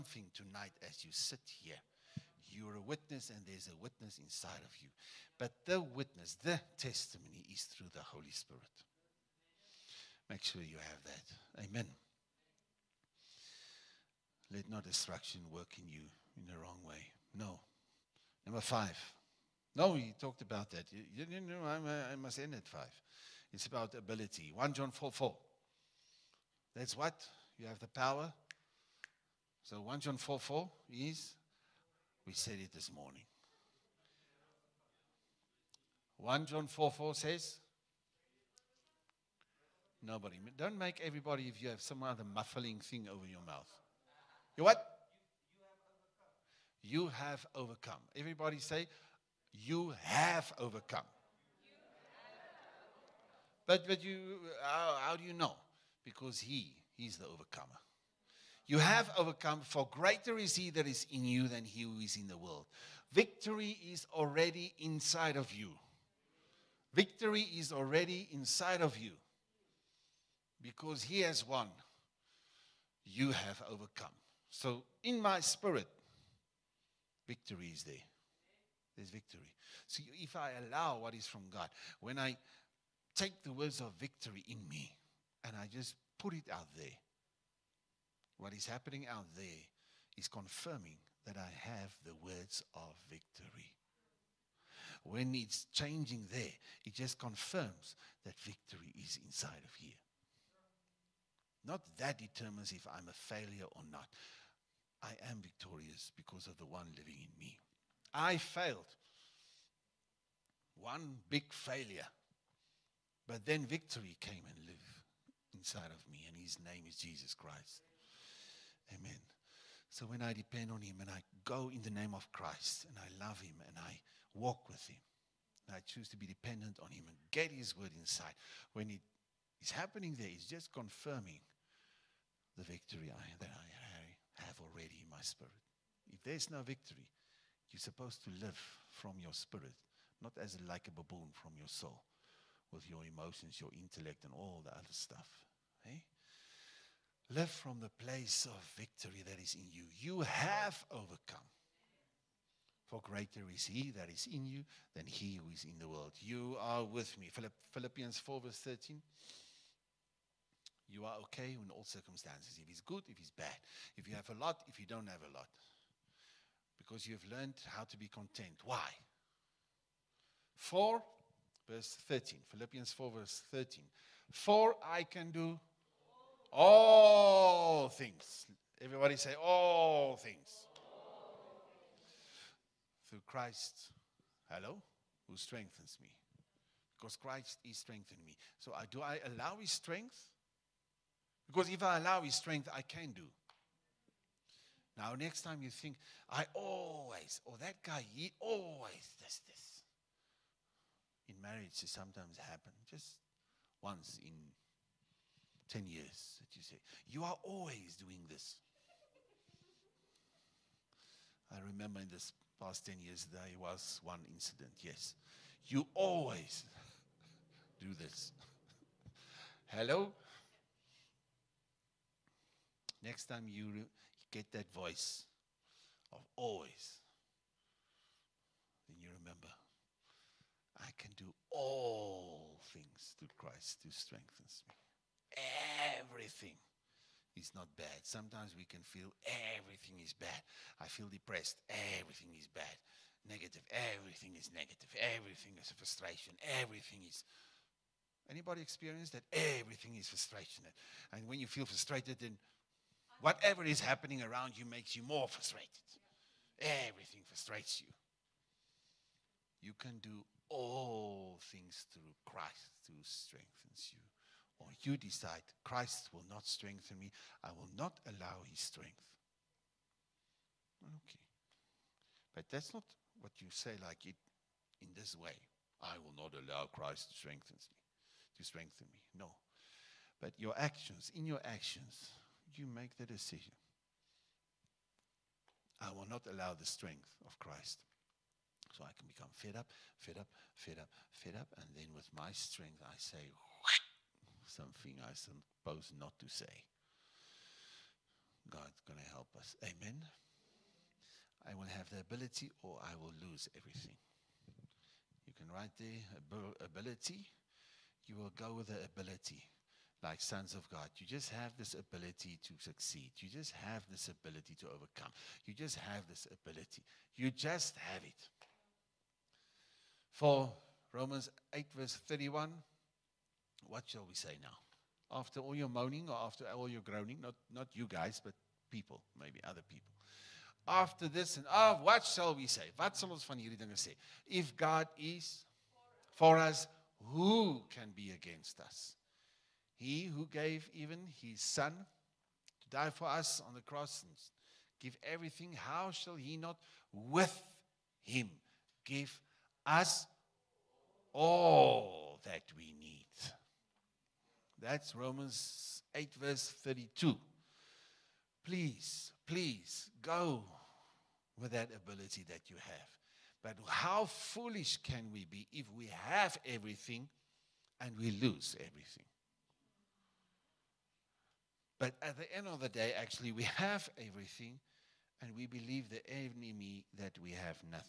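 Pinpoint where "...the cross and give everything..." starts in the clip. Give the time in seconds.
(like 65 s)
343 s.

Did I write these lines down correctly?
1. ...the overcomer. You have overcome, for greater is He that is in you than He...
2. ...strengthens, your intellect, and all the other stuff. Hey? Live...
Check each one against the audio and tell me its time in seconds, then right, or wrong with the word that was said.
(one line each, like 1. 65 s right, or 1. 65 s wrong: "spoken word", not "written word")
1. 57 s right
2. 143 s wrong: "emotions", not "strengthens".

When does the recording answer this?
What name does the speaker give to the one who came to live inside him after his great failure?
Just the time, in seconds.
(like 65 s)
116 s.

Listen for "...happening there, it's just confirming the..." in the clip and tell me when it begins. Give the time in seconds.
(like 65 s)
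129 s.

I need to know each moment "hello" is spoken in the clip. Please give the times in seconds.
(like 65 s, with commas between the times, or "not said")
184 s, 219 s.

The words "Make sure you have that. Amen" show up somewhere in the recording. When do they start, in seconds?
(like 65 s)
10 s.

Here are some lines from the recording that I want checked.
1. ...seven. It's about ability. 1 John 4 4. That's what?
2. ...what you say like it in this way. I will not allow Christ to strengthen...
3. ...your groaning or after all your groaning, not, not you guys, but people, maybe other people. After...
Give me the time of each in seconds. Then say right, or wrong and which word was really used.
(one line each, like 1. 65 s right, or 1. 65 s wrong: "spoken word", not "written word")
1. 22 s wrong: "five", not "seven"
2. 273 s right
3. 325 s wrong: "moaning", not "groaning".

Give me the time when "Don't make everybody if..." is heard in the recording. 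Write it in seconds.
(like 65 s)
40 s.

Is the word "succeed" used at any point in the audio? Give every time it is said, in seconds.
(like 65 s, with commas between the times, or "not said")
312 s.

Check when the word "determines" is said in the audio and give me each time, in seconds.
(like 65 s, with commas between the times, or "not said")
102 s.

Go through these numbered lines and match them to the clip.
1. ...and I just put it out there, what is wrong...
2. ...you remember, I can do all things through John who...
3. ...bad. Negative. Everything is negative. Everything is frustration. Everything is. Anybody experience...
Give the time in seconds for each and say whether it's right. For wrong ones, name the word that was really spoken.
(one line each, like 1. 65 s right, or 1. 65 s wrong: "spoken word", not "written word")
1. 85 s wrong: "happening", not "wrong"
2. 228 s wrong: "Christ", not "John"
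3. 242 s right.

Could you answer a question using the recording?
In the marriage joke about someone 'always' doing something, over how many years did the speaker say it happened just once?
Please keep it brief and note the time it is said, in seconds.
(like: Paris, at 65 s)
10, at 203 s.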